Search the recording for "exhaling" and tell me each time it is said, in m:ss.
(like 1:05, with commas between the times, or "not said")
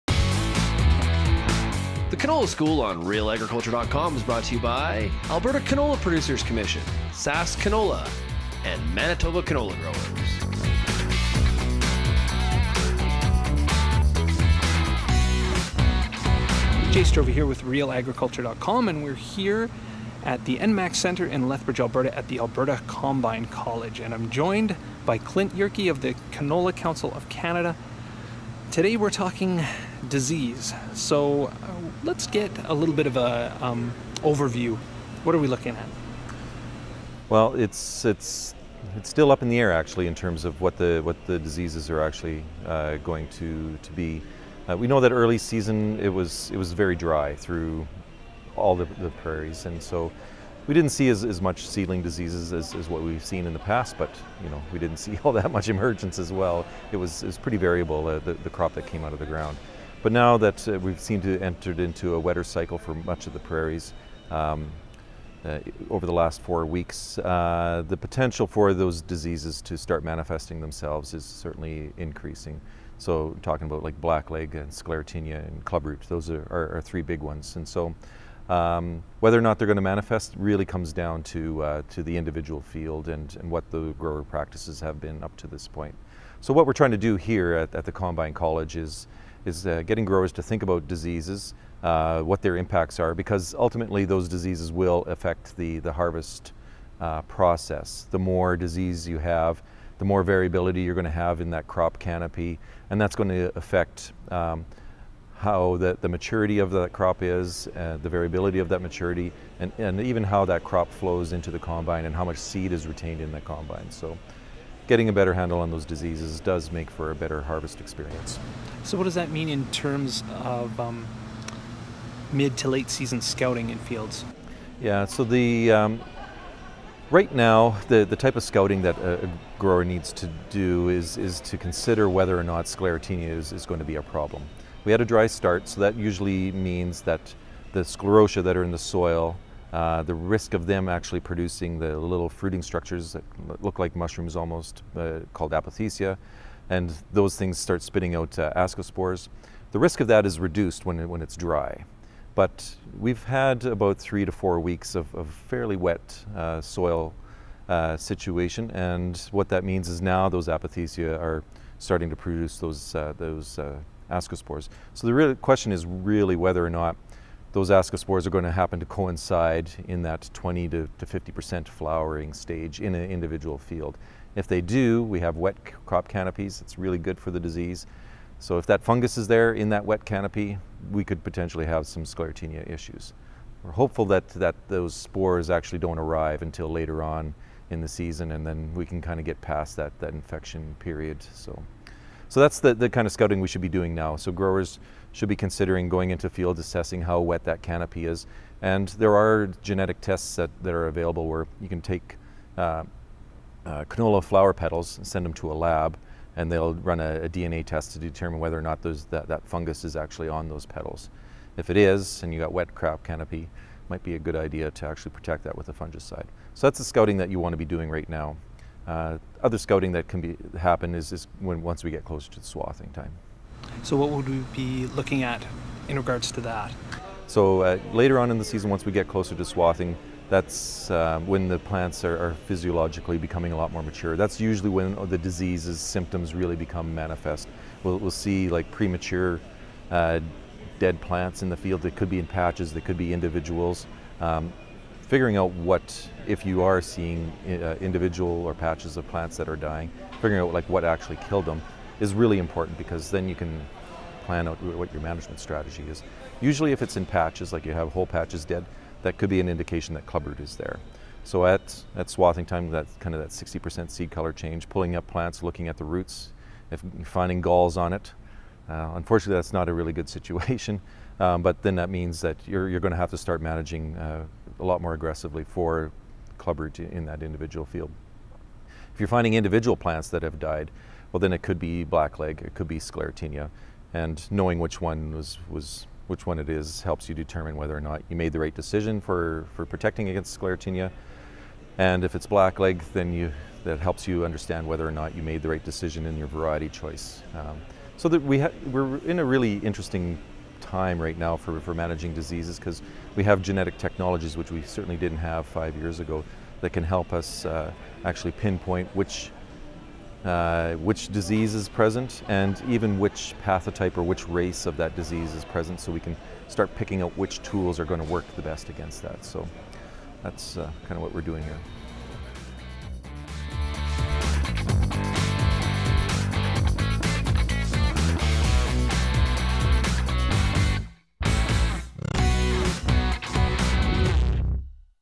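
not said.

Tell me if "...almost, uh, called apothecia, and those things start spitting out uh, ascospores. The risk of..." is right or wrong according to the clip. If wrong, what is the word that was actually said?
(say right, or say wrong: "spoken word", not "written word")
right.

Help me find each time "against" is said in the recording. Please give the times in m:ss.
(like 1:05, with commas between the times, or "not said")
4:50, 5:18.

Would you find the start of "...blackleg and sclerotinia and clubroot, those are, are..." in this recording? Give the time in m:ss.
1:13.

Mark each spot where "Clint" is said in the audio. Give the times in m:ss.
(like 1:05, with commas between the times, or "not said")
0:25.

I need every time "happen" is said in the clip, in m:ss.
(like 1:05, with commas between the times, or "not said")
2:48, 3:40.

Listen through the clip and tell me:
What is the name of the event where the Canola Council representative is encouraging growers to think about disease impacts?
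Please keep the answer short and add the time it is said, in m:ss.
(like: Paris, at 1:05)
Alberta Combine College, at 0:22.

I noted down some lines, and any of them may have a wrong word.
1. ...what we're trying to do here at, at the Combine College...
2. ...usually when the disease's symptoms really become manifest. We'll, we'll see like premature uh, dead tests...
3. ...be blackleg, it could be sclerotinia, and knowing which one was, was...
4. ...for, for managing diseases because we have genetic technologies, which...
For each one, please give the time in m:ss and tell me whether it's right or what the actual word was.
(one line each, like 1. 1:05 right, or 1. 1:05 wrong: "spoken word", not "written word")
1. 1:26 right
2. 3:54 wrong: "plants", not "tests"
3. 4:41 right
4. 5:01 right.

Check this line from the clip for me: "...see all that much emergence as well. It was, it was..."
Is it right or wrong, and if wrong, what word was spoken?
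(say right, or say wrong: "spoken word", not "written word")
right.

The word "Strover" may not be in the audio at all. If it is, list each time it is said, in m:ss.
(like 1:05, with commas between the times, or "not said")
0:17.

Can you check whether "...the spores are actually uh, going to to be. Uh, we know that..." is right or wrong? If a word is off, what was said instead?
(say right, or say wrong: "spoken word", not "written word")
wrong: "diseases", not "spores".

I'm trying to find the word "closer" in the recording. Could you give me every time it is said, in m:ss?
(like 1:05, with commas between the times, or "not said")
3:42, 3:49.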